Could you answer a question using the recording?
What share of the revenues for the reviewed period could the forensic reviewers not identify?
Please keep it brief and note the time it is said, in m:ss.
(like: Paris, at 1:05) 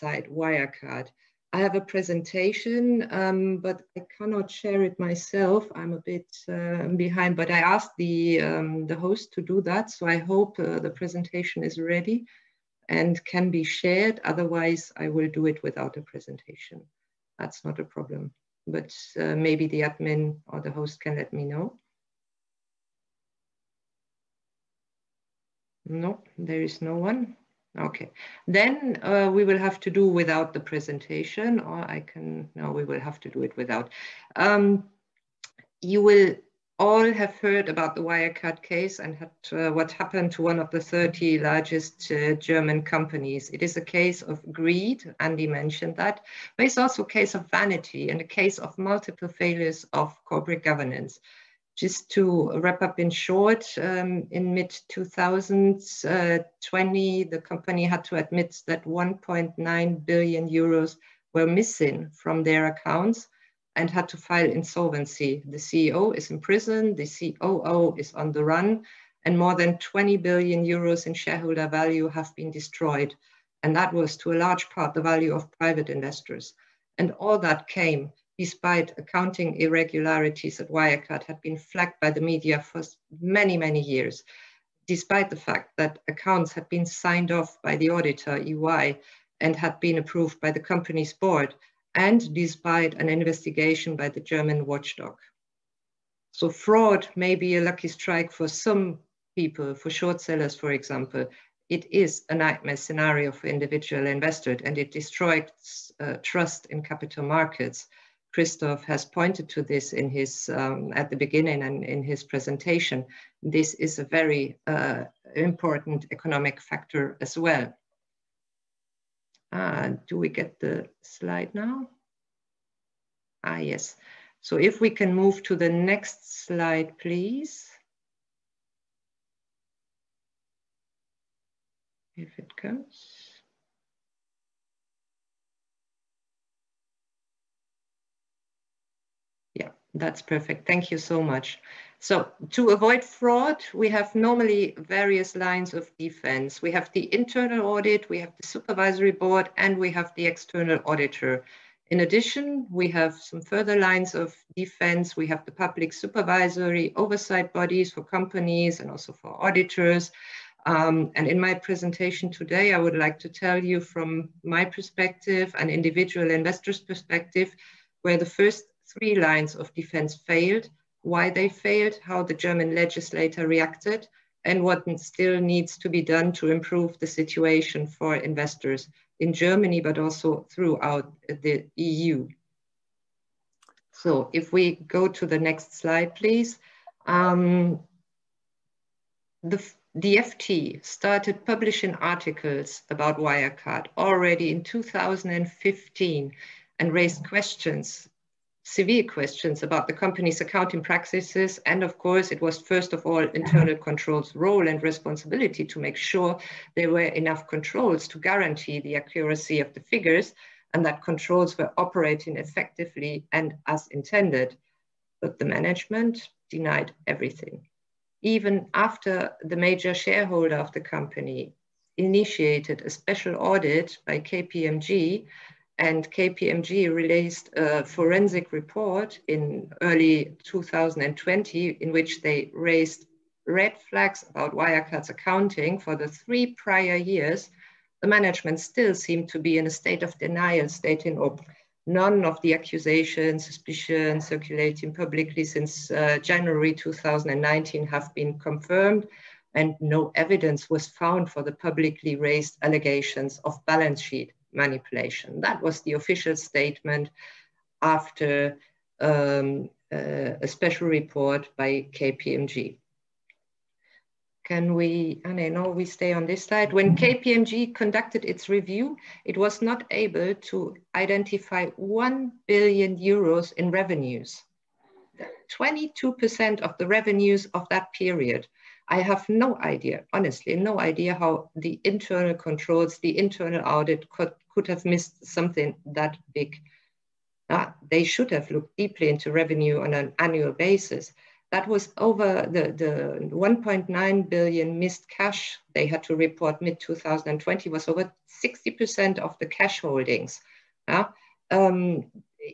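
22%, at 4:35.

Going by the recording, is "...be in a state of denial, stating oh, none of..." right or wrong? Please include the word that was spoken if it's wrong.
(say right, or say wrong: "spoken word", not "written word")
right.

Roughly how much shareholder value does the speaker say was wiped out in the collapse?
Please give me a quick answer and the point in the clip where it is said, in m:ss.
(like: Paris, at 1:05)
more than 20 billion euros, at 1:09.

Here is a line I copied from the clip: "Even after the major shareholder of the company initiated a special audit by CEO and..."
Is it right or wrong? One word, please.
wrong.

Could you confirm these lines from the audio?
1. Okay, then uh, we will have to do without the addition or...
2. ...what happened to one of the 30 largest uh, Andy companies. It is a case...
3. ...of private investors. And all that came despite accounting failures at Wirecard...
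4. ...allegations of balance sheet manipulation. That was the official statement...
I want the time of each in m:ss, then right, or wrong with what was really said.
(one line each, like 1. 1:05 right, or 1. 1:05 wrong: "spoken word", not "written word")
1. 0:27 wrong: "presentation", not "addition"
2. 0:39 wrong: "German", not "Andy"
3. 1:15 wrong: "irregularities", not "failures"
4. 4:12 right.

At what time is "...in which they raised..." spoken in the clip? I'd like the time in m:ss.
3:51.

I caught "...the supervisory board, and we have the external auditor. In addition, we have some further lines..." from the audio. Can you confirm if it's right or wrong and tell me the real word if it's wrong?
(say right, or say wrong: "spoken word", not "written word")
right.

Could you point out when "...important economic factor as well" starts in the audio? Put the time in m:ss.
1:55.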